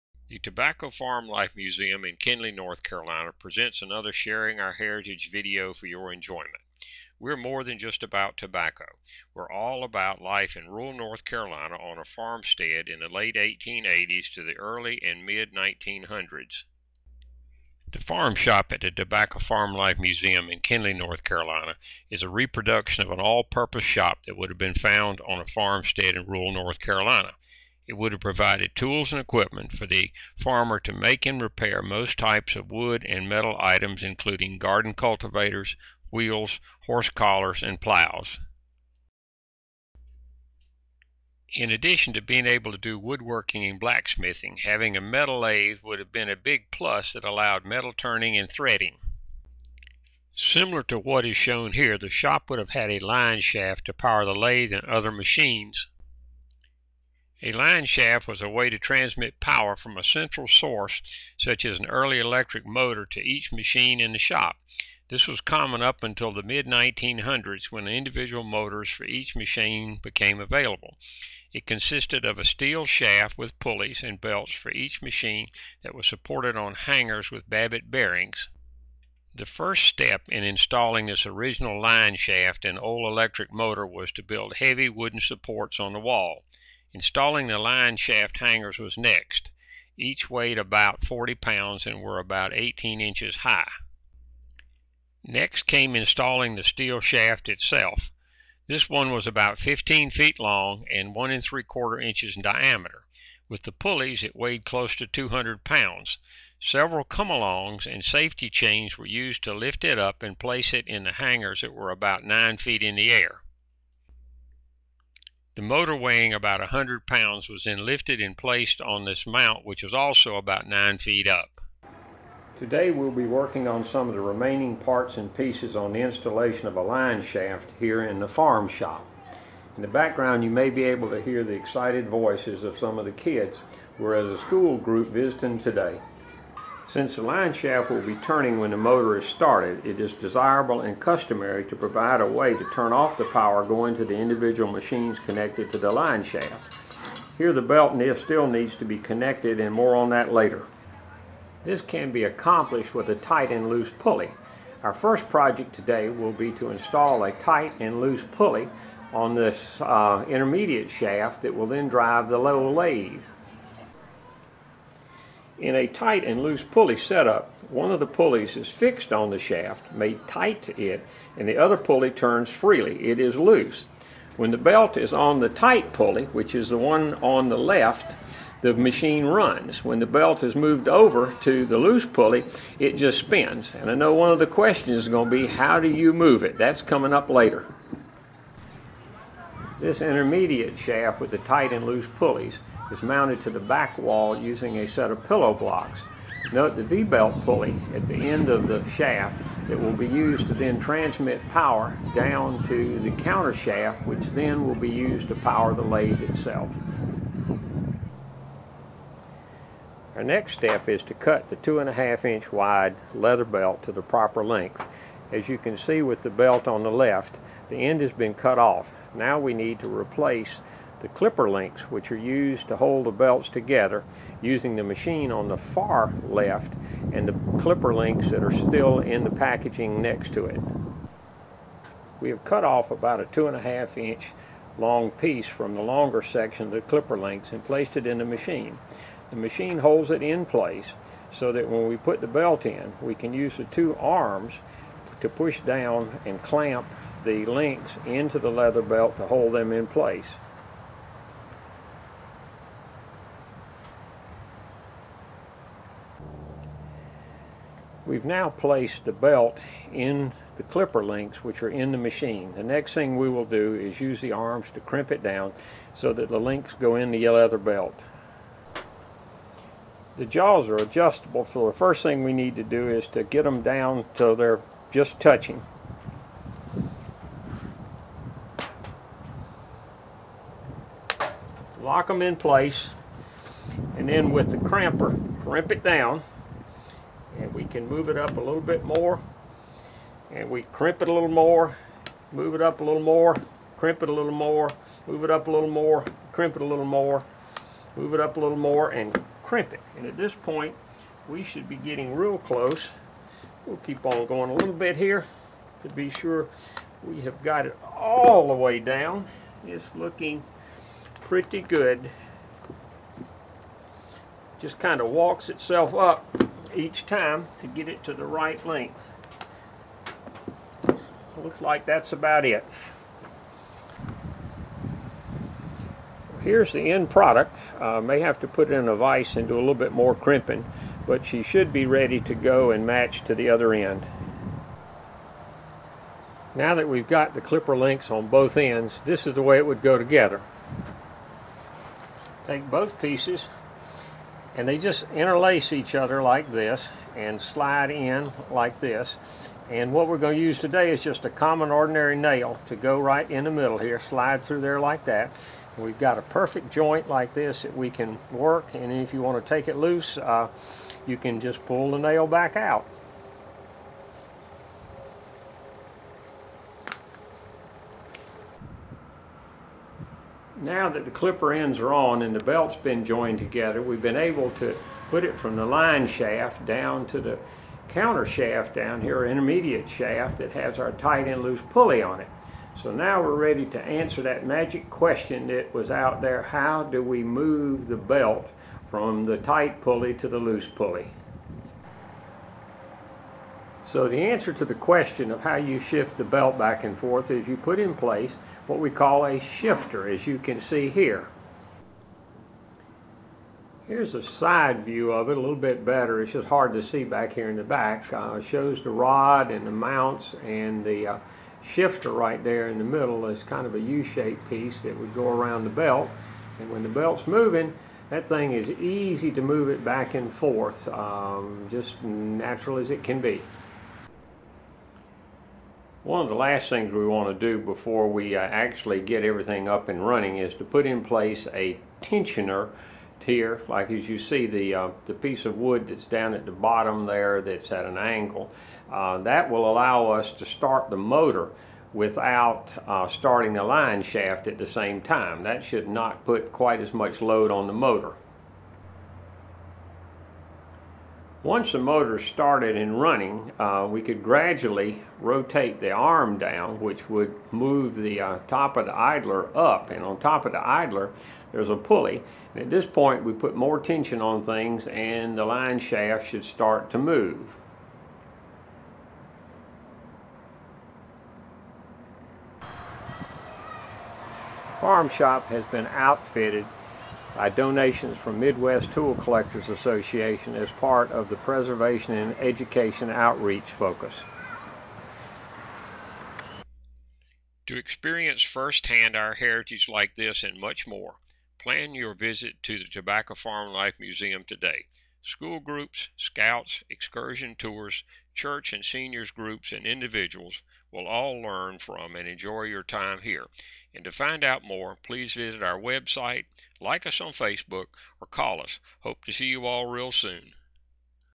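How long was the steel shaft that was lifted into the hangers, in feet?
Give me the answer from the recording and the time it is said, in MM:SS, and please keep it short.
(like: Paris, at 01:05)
15 feet, at 01:39.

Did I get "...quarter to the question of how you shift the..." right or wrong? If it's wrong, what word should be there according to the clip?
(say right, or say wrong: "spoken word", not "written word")
wrong: "answer", not "quarter".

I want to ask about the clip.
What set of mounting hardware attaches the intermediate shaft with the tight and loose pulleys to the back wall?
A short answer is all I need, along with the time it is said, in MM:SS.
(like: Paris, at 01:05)
Pillow blocks, at 03:15.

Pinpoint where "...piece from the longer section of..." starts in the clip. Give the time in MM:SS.
03:55.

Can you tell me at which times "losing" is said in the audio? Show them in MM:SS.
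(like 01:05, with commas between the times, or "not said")
not said.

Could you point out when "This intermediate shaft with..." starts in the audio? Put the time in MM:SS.
03:09.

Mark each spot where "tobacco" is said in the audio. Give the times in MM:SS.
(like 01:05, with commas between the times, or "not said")
00:00, 00:08, 00:18, 08:12.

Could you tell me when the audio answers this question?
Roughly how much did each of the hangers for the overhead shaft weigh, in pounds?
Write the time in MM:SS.
01:31.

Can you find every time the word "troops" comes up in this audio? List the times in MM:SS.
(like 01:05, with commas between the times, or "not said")
not said.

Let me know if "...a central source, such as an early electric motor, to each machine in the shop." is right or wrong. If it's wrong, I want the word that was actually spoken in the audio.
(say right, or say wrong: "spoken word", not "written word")
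right.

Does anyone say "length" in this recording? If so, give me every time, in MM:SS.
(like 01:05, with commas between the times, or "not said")
03:34, 05:18.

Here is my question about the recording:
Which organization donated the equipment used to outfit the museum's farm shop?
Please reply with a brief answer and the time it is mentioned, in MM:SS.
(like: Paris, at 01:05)
Midwest Tool Collectors Association, at 07:58.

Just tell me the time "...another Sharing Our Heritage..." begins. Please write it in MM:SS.
00:03.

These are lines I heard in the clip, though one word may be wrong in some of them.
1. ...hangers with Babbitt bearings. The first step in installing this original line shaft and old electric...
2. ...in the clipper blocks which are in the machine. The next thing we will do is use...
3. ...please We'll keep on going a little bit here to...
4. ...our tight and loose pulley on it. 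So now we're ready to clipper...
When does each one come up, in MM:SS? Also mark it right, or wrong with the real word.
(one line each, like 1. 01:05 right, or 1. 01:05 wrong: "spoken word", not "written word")
1. 01:16 right
2. 04:19 wrong: "links", not "blocks"
3. 05:02 wrong: "close", not "please"
4. 06:20 wrong: "answer", not "clipper".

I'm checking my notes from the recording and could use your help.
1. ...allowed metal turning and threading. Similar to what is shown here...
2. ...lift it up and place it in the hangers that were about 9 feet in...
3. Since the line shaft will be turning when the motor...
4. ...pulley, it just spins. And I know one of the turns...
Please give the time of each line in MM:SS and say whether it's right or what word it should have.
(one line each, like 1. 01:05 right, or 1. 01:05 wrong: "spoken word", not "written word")
1. 00:47 right
2. 01:49 right
3. 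02:16 right
4. 03:02 wrong: "questions", not "turns".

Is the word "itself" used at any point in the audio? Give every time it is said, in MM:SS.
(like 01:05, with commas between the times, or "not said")
01:37, 03:26, 05:15.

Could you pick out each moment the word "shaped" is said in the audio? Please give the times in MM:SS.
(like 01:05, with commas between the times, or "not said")
06:53.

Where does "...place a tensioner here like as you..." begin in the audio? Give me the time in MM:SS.
07:11.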